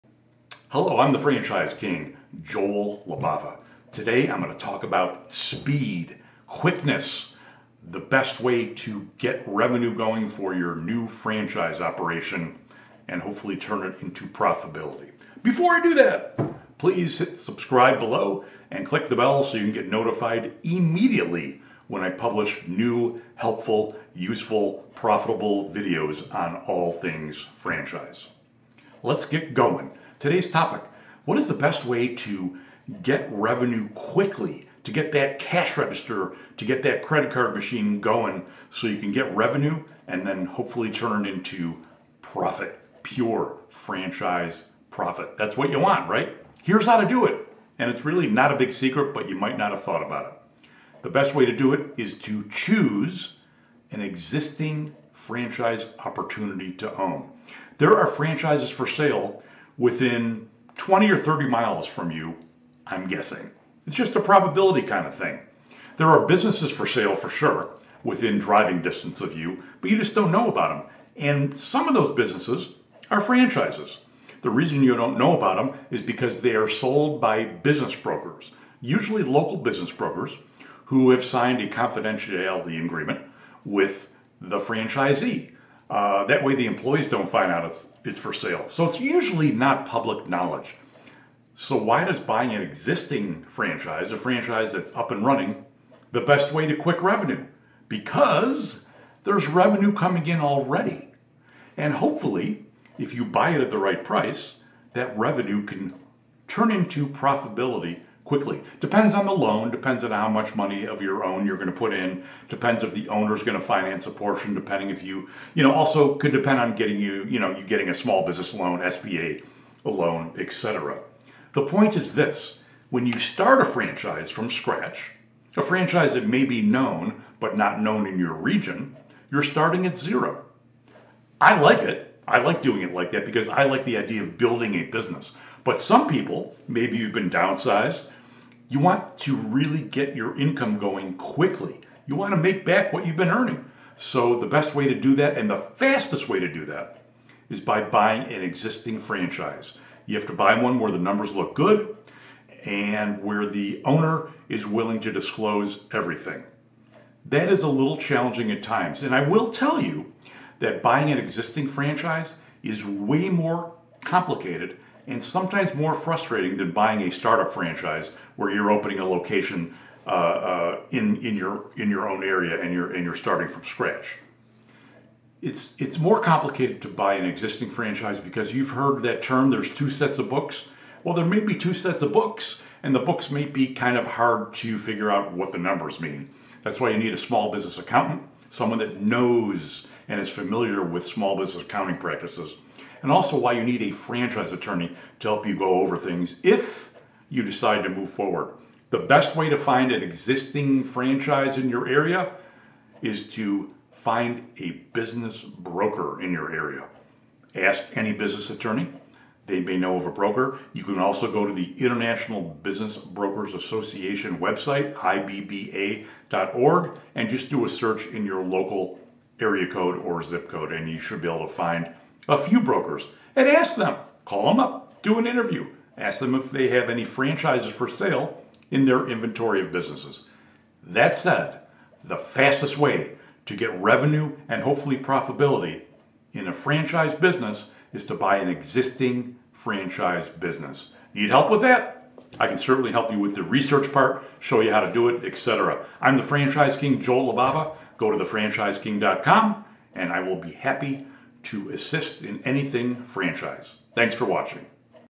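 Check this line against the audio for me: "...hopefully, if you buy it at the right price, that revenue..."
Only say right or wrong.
right.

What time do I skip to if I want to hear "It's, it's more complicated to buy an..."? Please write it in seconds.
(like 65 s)
175 s.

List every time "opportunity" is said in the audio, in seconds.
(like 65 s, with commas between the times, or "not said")
55 s.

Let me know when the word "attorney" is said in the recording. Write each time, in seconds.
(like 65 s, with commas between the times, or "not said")
194 s, 208 s.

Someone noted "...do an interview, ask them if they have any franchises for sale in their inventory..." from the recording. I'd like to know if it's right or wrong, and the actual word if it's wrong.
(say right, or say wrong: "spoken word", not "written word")
right.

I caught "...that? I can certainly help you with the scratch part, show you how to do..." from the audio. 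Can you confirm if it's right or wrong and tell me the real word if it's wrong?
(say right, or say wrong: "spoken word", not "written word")
wrong: "research", not "scratch".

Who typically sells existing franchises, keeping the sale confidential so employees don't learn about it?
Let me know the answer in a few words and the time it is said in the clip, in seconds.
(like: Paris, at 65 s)
Local business brokers, at 79 s.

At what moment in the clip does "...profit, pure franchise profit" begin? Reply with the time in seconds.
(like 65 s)
42 s.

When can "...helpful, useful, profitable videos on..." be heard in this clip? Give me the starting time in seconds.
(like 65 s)
23 s.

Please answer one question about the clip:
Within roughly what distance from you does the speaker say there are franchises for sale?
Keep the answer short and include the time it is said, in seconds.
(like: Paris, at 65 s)
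20 or 30 miles, at 60 s.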